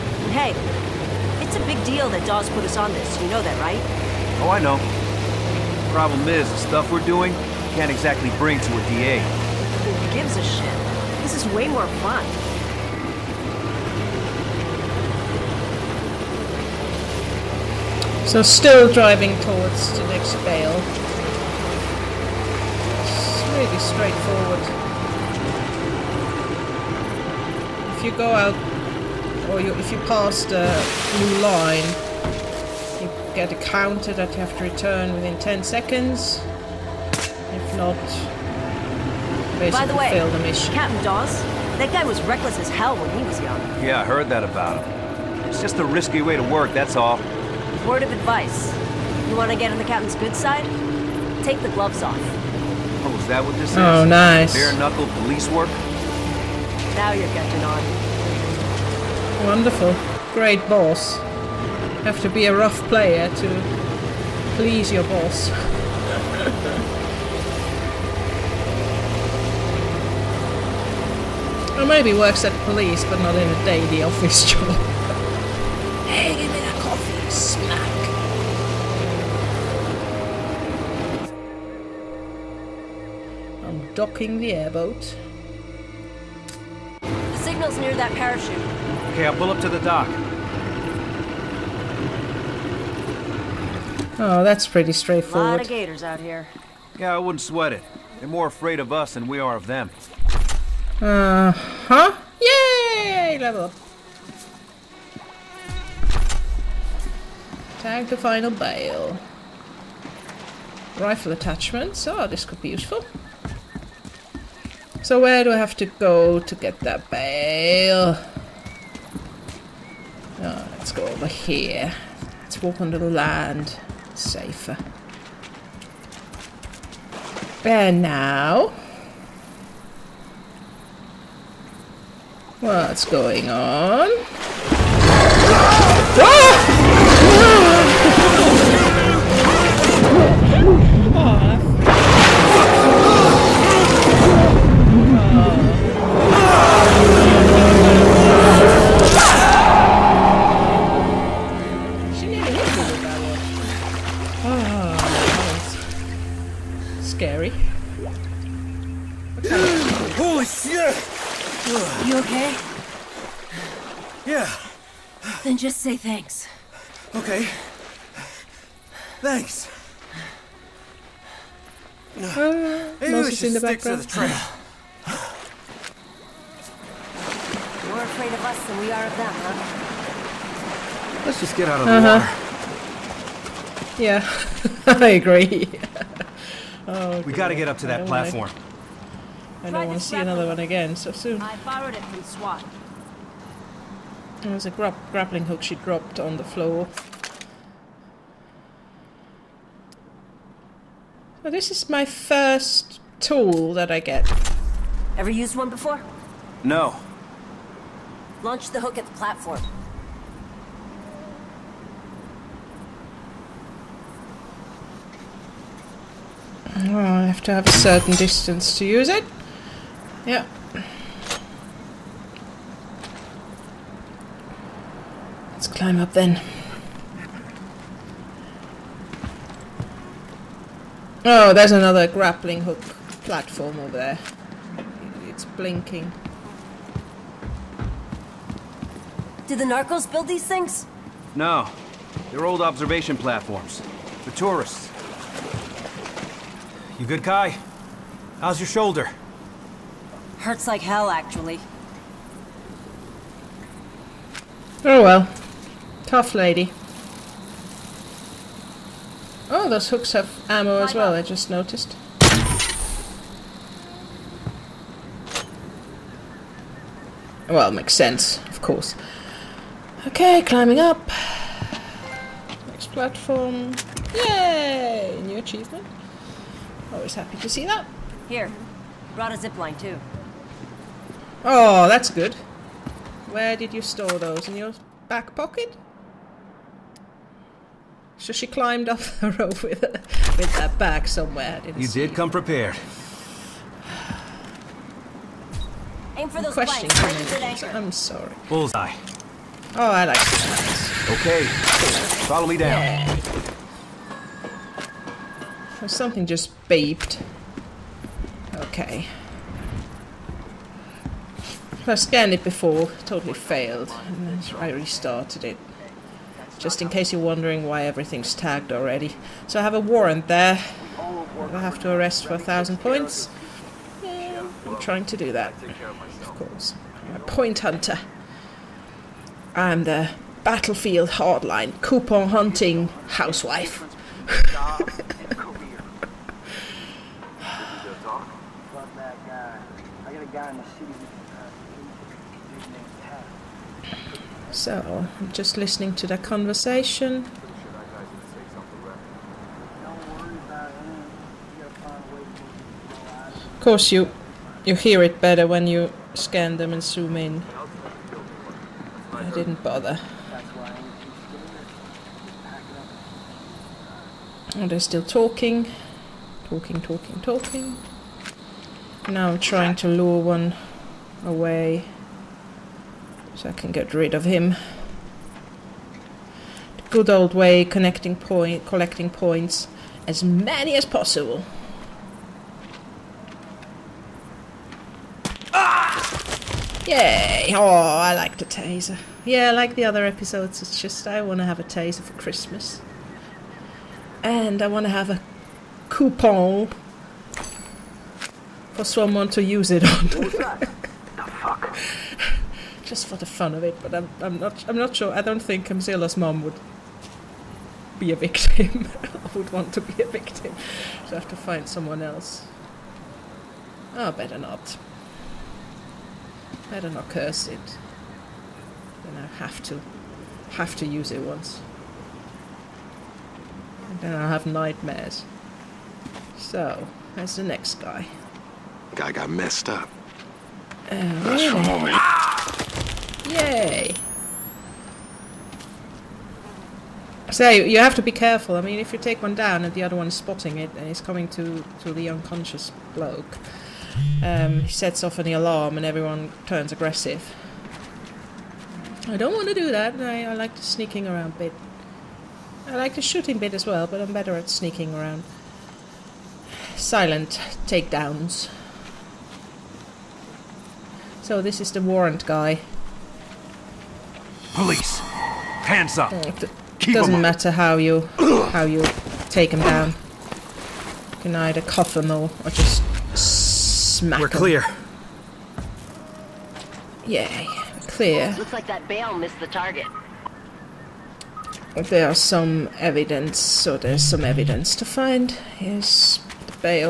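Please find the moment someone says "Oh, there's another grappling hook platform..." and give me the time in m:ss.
3:51.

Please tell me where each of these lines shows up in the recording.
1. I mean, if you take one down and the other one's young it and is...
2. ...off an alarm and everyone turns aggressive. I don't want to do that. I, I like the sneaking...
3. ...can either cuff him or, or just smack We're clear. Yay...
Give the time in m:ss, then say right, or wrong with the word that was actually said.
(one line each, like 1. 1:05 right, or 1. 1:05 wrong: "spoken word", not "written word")
1. 7:18 wrong: "spotting", not "young"
2. 7:25 right
3. 7:51 right.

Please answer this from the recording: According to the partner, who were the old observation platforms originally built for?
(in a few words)
Tourists.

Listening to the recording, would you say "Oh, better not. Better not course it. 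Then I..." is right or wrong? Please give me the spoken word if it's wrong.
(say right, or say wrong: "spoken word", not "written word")
wrong: "curse", not "course".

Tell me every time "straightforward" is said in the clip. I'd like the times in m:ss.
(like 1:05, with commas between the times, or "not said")
0:23, 1:34.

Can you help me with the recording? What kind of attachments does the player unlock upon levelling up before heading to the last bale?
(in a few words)
Rifle attachments.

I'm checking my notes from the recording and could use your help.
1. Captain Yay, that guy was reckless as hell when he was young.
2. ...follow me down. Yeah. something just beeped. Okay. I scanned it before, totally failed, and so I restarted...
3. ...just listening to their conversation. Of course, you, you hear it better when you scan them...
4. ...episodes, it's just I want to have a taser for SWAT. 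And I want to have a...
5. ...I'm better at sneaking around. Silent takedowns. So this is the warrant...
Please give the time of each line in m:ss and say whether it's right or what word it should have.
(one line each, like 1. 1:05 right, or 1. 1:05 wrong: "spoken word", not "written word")
1. 0:40 wrong: "Dawes", not "Yay"
2. 5:02 right
3. 5:45 right
4. 6:30 wrong: "Christmas", not "SWAT"
5. 7:34 right.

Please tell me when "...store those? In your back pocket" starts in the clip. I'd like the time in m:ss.
4:43.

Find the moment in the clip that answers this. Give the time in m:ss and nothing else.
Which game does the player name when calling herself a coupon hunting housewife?
5:30.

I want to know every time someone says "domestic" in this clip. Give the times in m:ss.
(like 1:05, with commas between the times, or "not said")
not said.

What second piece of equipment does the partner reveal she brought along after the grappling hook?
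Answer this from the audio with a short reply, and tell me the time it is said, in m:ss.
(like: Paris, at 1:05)
A zip line, at 4:39.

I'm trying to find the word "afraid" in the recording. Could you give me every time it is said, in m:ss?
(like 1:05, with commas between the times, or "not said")
1:38, 2:58.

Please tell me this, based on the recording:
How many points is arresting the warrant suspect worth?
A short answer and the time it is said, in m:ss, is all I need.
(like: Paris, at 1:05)
1000, at 5:22.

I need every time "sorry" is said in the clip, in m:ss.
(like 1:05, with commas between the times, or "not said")
4:57.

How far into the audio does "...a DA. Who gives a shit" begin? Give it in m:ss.
0:08.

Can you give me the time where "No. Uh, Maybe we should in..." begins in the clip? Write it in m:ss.
2:52.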